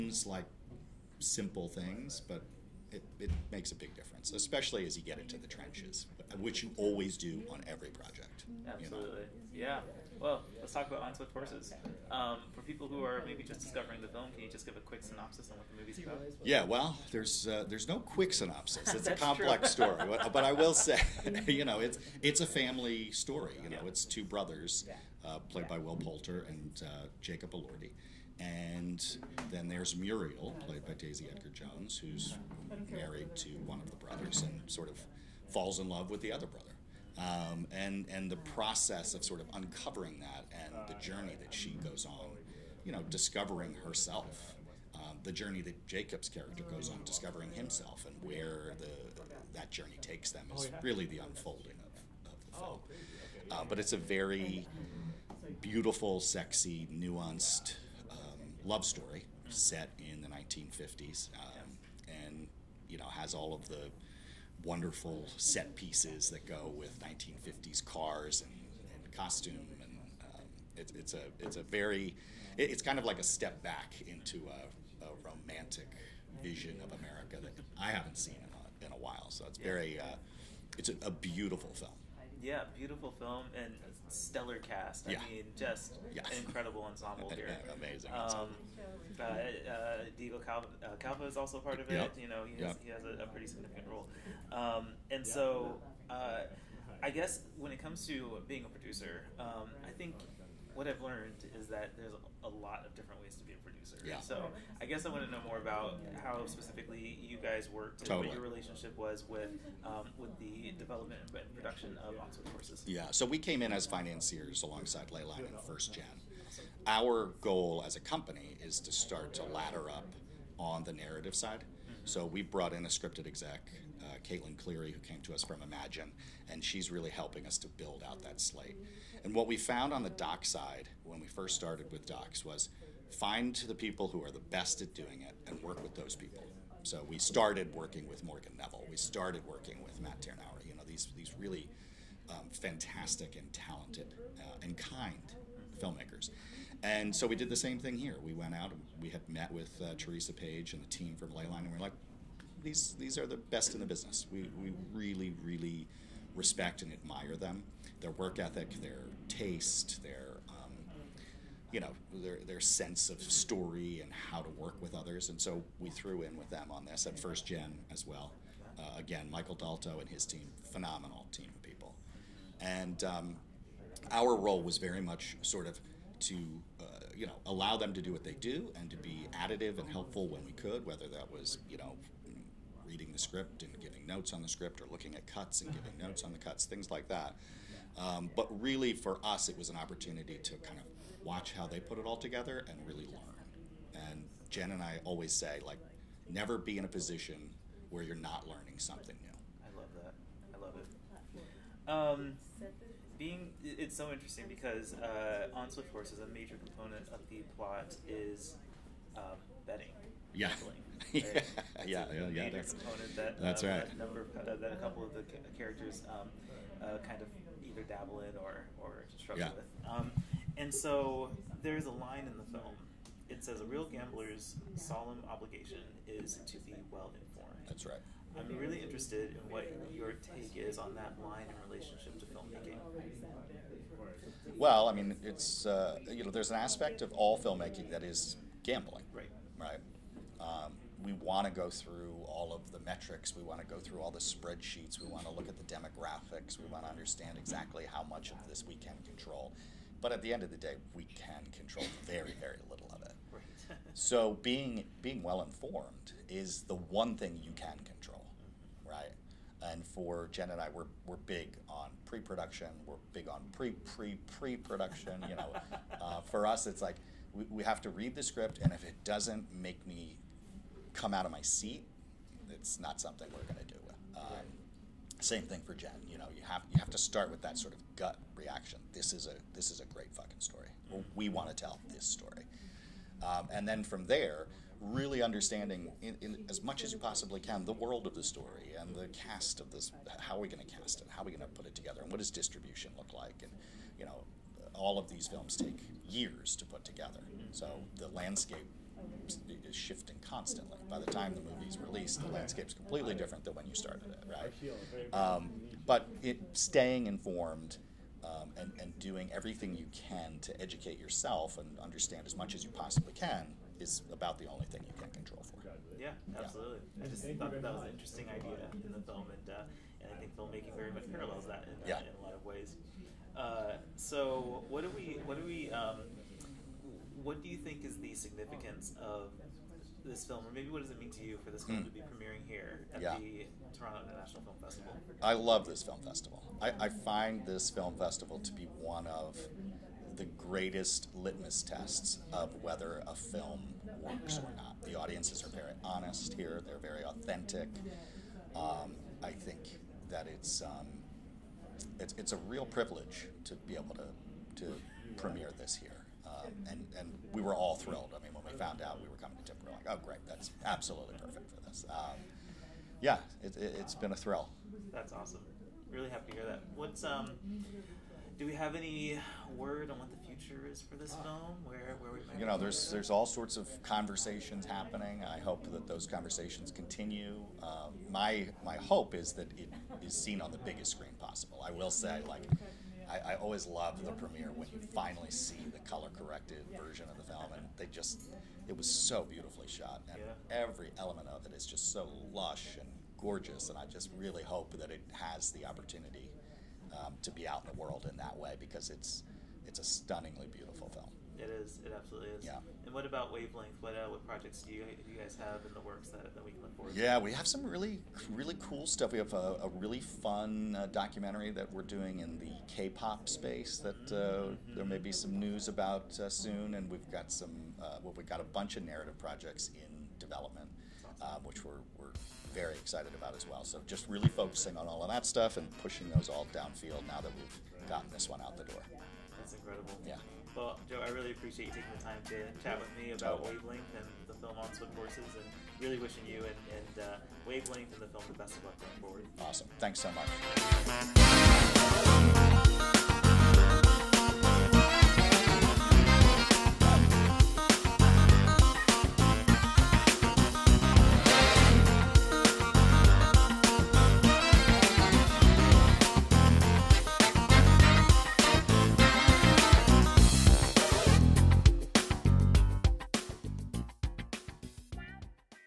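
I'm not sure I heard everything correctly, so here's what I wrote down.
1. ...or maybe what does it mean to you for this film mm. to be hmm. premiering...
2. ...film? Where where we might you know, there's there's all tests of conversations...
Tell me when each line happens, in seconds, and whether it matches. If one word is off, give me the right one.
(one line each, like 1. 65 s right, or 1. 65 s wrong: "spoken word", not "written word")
1. 330 s right
2. 371 s wrong: "sorts", not "tests".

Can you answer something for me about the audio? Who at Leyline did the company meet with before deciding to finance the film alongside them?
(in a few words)
Teresa Page.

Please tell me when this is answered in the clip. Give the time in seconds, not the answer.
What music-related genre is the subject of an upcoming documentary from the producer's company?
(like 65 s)
412 s.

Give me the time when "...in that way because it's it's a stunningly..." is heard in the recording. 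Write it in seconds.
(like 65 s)
398 s.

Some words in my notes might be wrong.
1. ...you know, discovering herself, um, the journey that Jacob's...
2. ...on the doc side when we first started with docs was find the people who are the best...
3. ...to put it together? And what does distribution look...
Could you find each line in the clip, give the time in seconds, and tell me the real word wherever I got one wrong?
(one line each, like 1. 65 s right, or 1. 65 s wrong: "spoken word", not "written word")
1. 42 s right
2. 129 s right
3. 291 s right.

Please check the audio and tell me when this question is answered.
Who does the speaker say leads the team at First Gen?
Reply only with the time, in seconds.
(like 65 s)
169 s.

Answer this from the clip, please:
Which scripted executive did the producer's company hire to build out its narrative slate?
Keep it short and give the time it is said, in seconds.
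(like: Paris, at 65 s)
Caitlin Cleary, at 124 s.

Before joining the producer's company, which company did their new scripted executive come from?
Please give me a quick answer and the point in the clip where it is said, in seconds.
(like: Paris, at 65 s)
Imagine, at 125 s.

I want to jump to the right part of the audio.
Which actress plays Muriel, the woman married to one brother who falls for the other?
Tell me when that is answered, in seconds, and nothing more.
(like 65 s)
30 s.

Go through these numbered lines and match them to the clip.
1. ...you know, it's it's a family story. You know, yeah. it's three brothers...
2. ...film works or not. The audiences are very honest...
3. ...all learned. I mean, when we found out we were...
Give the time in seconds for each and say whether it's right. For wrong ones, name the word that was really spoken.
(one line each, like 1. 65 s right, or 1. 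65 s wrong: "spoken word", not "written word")
1. 21 s wrong: "two", not "three"
2. 343 s right
3. 357 s wrong: "thrilled", not "learned".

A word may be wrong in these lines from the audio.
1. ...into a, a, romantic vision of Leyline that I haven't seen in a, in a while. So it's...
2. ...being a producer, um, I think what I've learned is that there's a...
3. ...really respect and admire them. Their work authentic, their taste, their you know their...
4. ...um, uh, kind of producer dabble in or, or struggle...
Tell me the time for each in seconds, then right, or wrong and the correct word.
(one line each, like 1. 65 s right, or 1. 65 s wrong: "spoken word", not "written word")
1. 74 s wrong: "America", not "Leyline"
2. 98 s right
3. 155 s wrong: "ethic", not "authentic"
4. 216 s wrong: "either", not "producer".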